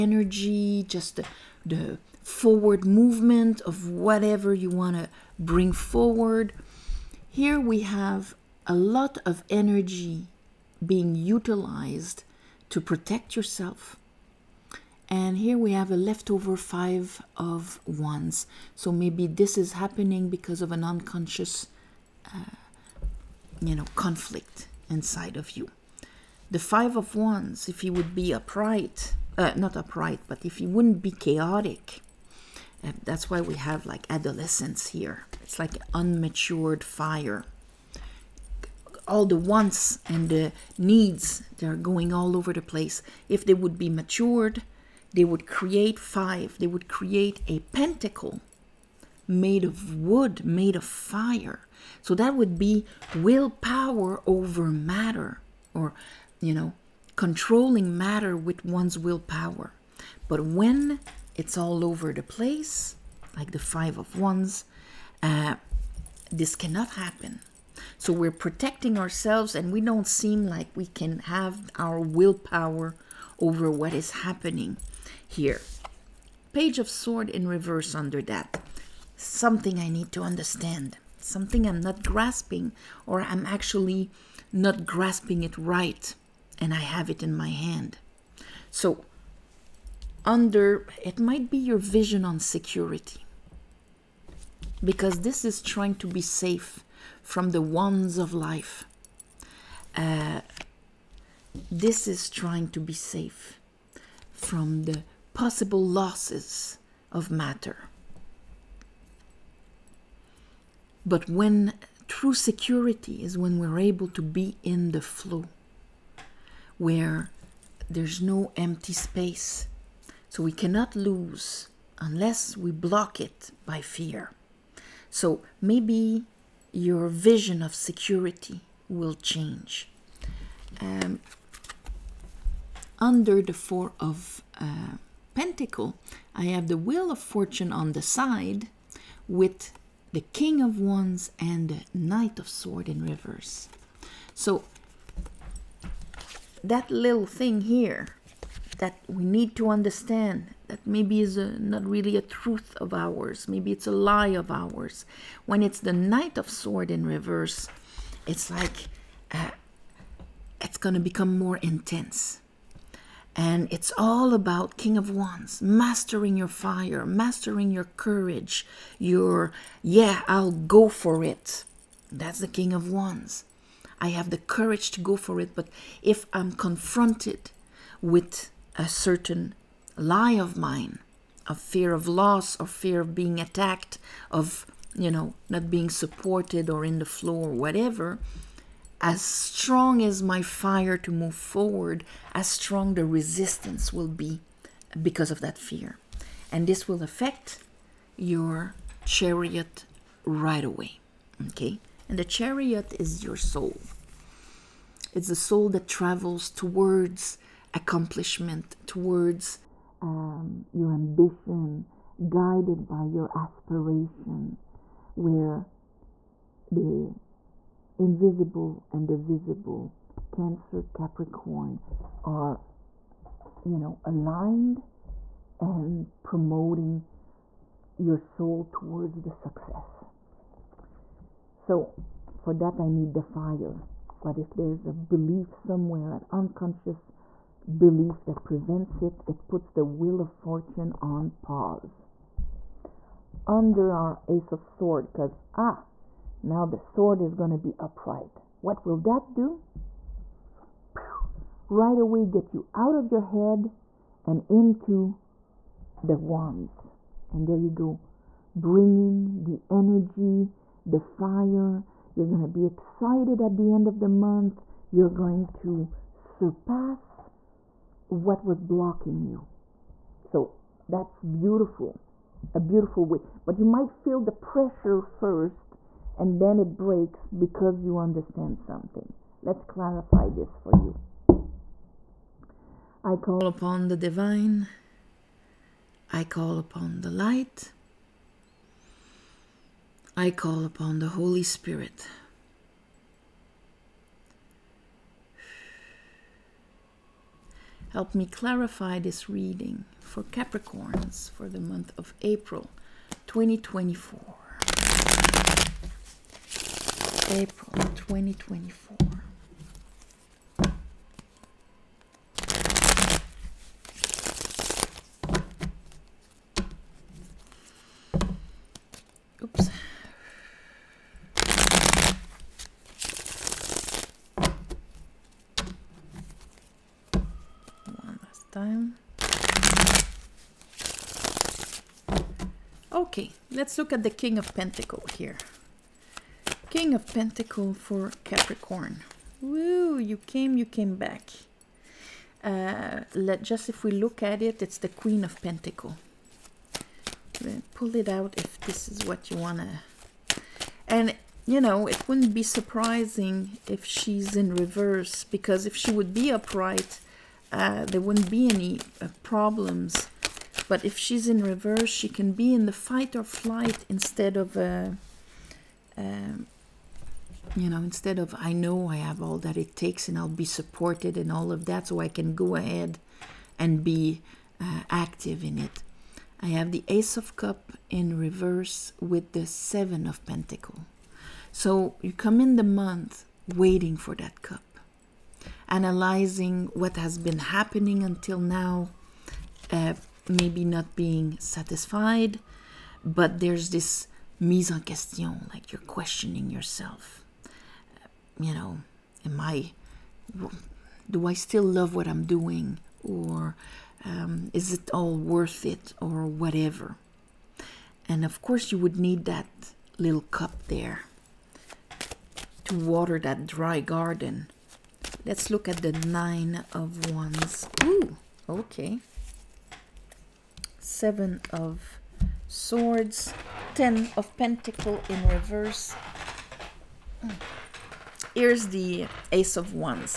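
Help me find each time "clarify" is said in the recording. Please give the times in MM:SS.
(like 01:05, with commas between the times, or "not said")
04:39, 04:58.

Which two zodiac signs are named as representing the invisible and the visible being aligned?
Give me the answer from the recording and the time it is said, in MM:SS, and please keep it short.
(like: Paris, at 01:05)
Cancer, Capricorn, at 03:40.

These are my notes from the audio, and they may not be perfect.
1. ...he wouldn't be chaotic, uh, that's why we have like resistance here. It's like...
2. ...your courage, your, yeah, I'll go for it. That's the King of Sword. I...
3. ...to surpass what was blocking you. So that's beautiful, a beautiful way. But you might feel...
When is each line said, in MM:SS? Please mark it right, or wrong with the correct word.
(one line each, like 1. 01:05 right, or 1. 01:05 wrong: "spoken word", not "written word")
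1. 00:30 wrong: "adolescence", not "resistance"
2. 02:47 wrong: "Wands", not "Sword"
3. 04:25 right.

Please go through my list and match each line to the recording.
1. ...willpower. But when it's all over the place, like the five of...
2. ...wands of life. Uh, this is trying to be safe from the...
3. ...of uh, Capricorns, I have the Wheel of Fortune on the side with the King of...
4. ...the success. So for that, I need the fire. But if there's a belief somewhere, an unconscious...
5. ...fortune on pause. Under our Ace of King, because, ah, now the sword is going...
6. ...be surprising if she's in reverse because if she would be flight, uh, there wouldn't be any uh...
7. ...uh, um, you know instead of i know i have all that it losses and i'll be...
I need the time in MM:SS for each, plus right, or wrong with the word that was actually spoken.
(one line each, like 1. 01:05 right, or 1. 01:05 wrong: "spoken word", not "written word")
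1. 00:58 right
2. 01:37 right
3. 02:13 wrong: "Pentacle", not "Capricorns"
4. 03:49 right
5. 04:00 wrong: "Sword", not "King"
6. 05:52 wrong: "upright", not "flight"
7. 06:05 wrong: "takes", not "losses".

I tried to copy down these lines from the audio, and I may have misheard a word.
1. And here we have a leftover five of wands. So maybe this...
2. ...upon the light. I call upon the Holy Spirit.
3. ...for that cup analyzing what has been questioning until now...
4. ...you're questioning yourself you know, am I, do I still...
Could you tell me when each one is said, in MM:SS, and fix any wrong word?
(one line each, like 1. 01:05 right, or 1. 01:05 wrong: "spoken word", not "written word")
1. 00:15 right
2. 04:46 right
3. 06:23 wrong: "happening", not "questioning"
4. 06:35 right.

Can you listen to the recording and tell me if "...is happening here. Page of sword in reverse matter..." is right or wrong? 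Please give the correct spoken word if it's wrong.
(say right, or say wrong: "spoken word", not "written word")
wrong: "under", not "matter".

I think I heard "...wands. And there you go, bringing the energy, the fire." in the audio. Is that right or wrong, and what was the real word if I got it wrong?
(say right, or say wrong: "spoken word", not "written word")
right.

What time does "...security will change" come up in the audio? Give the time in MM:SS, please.
02:07.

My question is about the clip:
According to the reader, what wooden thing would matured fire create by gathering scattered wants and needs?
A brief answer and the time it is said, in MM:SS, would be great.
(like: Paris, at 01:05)
A pentacle, at 00:47.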